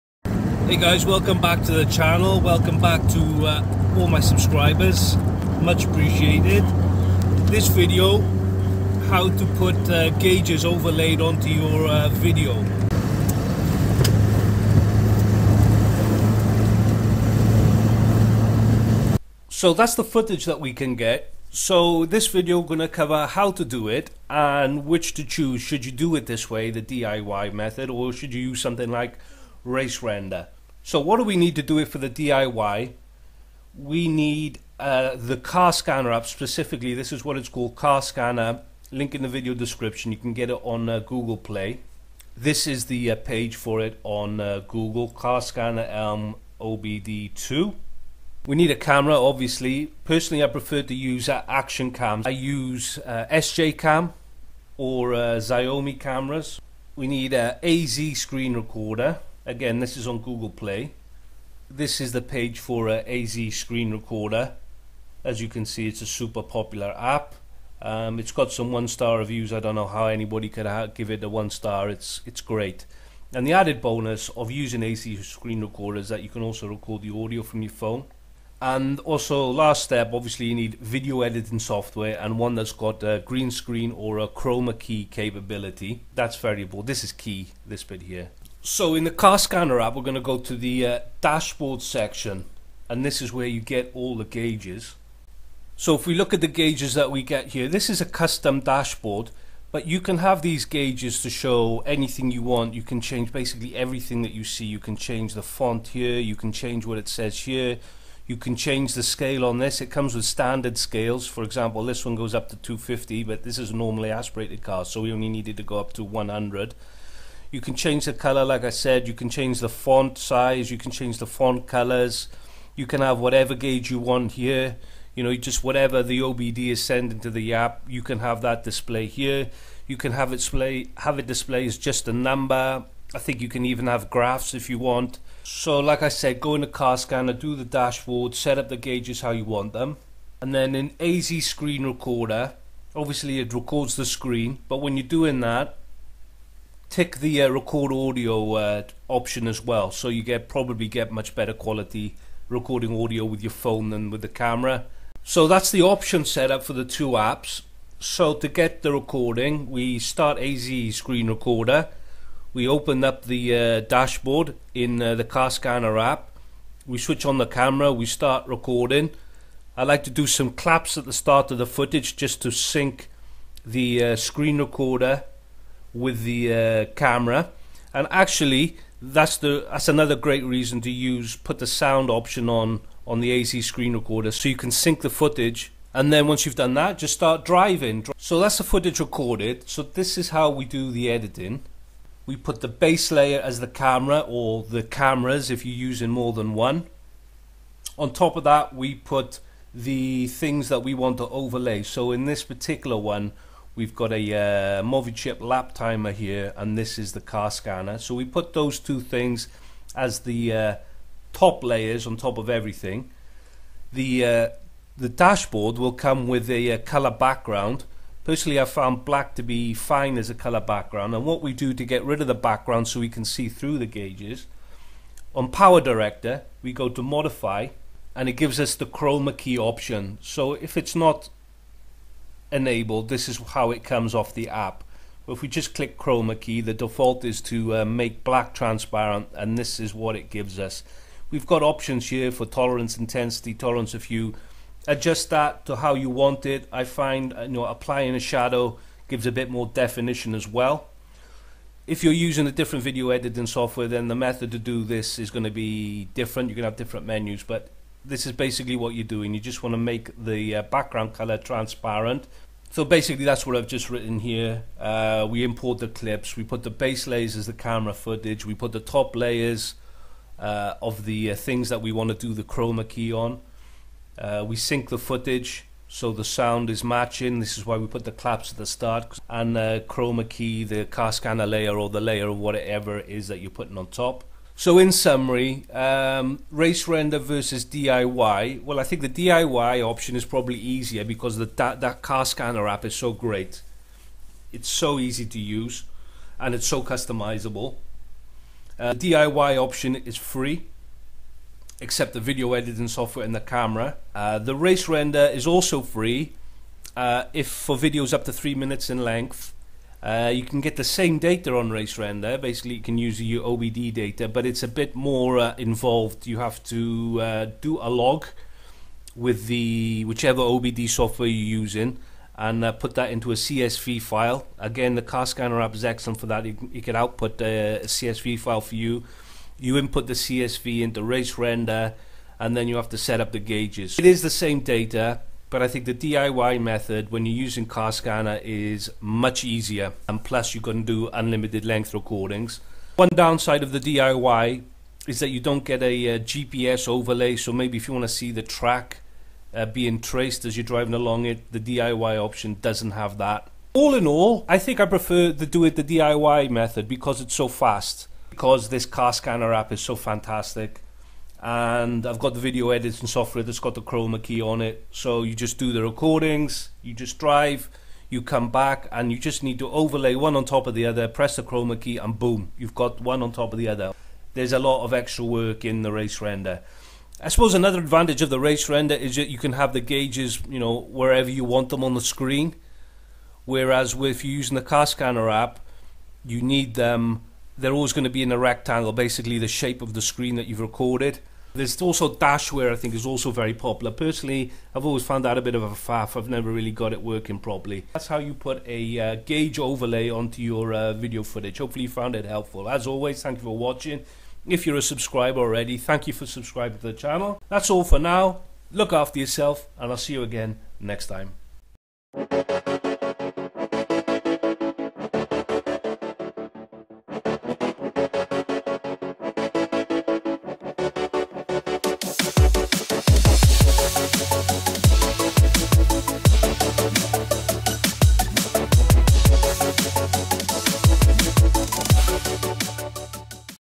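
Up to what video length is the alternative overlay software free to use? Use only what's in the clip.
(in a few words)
3 minutes.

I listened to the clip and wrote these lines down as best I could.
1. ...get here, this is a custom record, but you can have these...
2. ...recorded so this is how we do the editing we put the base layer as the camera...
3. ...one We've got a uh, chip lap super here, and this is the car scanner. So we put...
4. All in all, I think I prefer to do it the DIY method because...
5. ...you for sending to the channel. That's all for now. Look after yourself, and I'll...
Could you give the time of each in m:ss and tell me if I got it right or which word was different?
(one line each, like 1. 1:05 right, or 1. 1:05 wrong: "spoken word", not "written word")
1. 1:37 wrong: "dashboard", not "record"
2. 3:08 right
3. 3:22 wrong: "timer", not "super"
4. 5:53 right
5. 6:46 wrong: "subscribing", not "sending".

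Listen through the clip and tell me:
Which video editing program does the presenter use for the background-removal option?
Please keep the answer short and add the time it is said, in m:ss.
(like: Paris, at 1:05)
PowerDirector, at 3:45.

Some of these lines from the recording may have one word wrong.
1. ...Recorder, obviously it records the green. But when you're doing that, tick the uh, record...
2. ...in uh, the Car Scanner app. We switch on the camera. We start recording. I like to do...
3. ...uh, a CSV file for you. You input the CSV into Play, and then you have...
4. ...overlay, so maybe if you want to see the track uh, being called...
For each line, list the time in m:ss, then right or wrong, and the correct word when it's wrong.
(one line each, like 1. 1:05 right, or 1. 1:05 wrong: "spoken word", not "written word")
1. 2:21 wrong: "screen", not "green"
2. 2:44 right
3. 5:27 wrong: "RaceRender", not "Play"
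4. 5:46 wrong: "traced", not "called".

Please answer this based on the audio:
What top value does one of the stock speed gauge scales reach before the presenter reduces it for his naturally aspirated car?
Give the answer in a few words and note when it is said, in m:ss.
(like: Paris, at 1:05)
250, at 1:52.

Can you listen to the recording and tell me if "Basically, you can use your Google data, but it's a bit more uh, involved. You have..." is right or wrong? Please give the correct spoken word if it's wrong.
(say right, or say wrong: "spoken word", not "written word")
wrong: "OBD", not "Google".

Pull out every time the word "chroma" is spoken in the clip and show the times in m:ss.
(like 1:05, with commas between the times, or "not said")
1:24, 3:48, 3:55, 4:32, 4:39, 6:03, 6:11.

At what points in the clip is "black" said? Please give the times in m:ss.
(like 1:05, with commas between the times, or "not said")
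3:39, 3:58.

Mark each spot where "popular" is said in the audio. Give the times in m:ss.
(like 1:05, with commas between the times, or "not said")
1:06, 6:33.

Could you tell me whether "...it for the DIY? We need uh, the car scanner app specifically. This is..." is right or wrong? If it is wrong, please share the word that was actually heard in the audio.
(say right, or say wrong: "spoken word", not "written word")
right.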